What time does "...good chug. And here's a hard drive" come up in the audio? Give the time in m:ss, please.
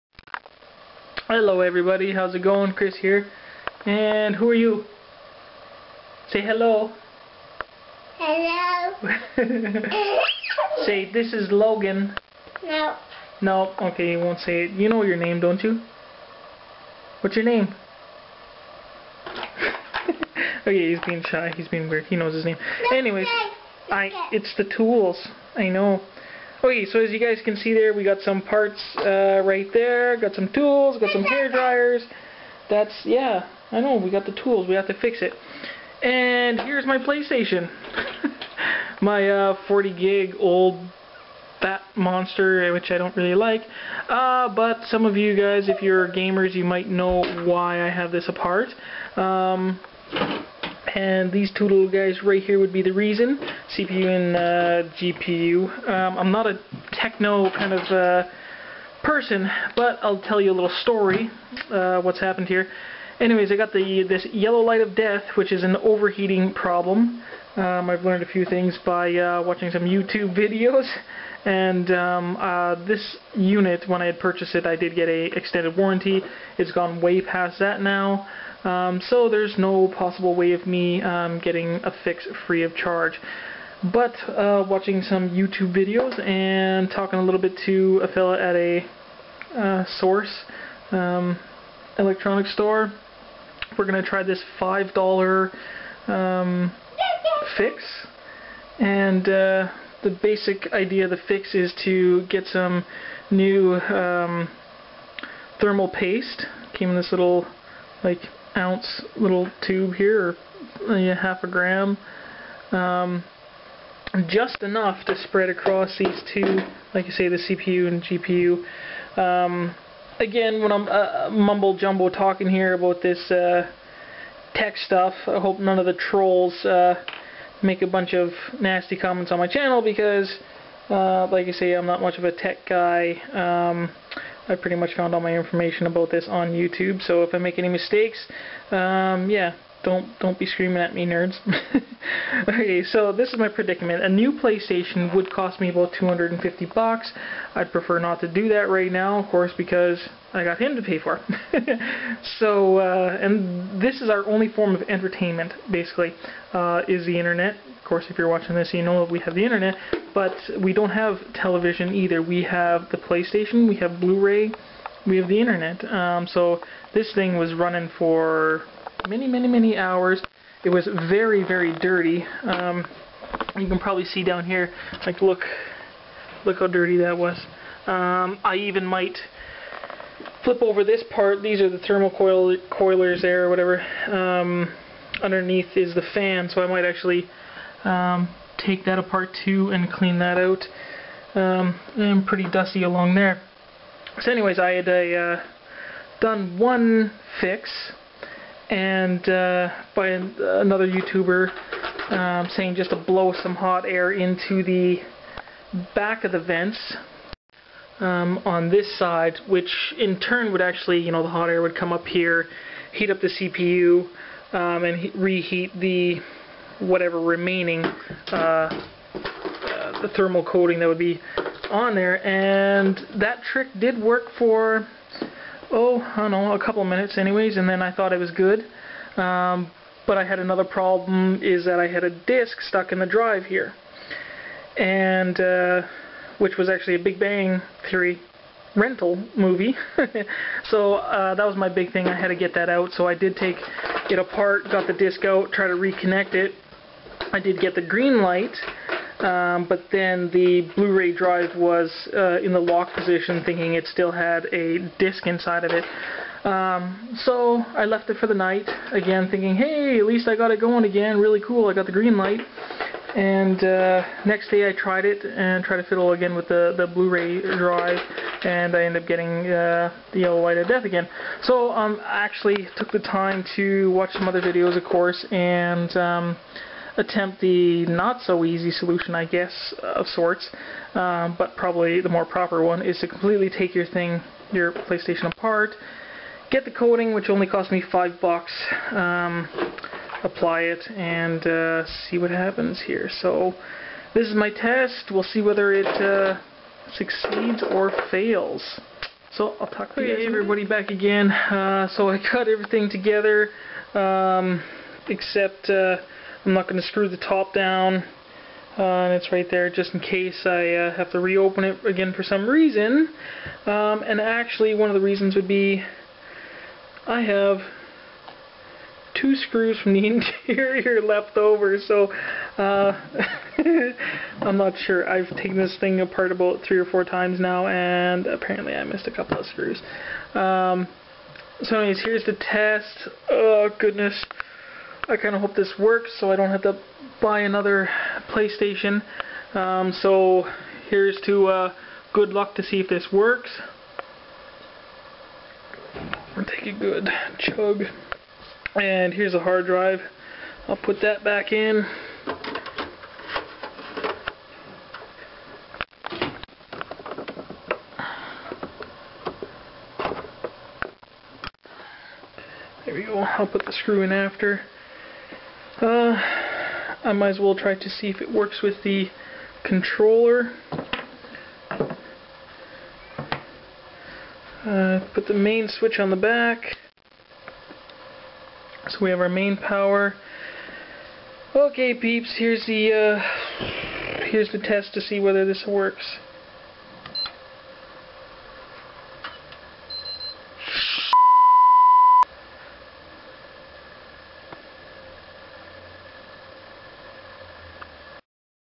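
5:46.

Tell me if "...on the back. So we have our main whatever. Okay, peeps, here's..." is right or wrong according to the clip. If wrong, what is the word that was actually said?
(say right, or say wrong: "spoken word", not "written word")
wrong: "power", not "whatever".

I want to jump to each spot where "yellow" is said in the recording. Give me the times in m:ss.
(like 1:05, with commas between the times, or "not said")
1:04, 4:30.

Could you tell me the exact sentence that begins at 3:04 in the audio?
Um, underneath is the fan, so I might actually um, take that apart too and clean that out.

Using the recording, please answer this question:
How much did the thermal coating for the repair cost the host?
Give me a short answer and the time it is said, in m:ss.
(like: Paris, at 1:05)
5 bucks, at 4:47.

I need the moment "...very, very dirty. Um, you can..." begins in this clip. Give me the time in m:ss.
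2:51.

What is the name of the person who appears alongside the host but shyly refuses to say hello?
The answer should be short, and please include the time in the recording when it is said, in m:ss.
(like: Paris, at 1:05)
Logan, at 0:11.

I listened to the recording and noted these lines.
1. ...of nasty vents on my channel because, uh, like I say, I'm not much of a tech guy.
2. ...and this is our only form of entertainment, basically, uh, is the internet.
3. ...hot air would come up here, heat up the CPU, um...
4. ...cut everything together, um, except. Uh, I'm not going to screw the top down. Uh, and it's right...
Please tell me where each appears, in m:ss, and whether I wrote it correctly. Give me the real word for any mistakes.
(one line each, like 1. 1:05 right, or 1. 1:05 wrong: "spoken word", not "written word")
1. 2:08 wrong: "comments", not "vents"
2. 2:33 right
3. 3:31 right
4. 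5:02 right.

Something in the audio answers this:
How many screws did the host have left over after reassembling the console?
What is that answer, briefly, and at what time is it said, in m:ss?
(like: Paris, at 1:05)
2, at 5:19.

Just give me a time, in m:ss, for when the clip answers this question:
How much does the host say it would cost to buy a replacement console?
2:25.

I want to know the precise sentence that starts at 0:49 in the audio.
Um, and these two little guys right here would be the reason, CPU and uh, GPU.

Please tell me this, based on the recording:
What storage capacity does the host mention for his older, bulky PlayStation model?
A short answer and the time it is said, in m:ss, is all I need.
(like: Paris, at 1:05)
40 gig, at 0:39.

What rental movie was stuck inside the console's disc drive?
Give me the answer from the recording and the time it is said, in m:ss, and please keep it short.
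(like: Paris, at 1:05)
Big Bang Theory, at 3:57.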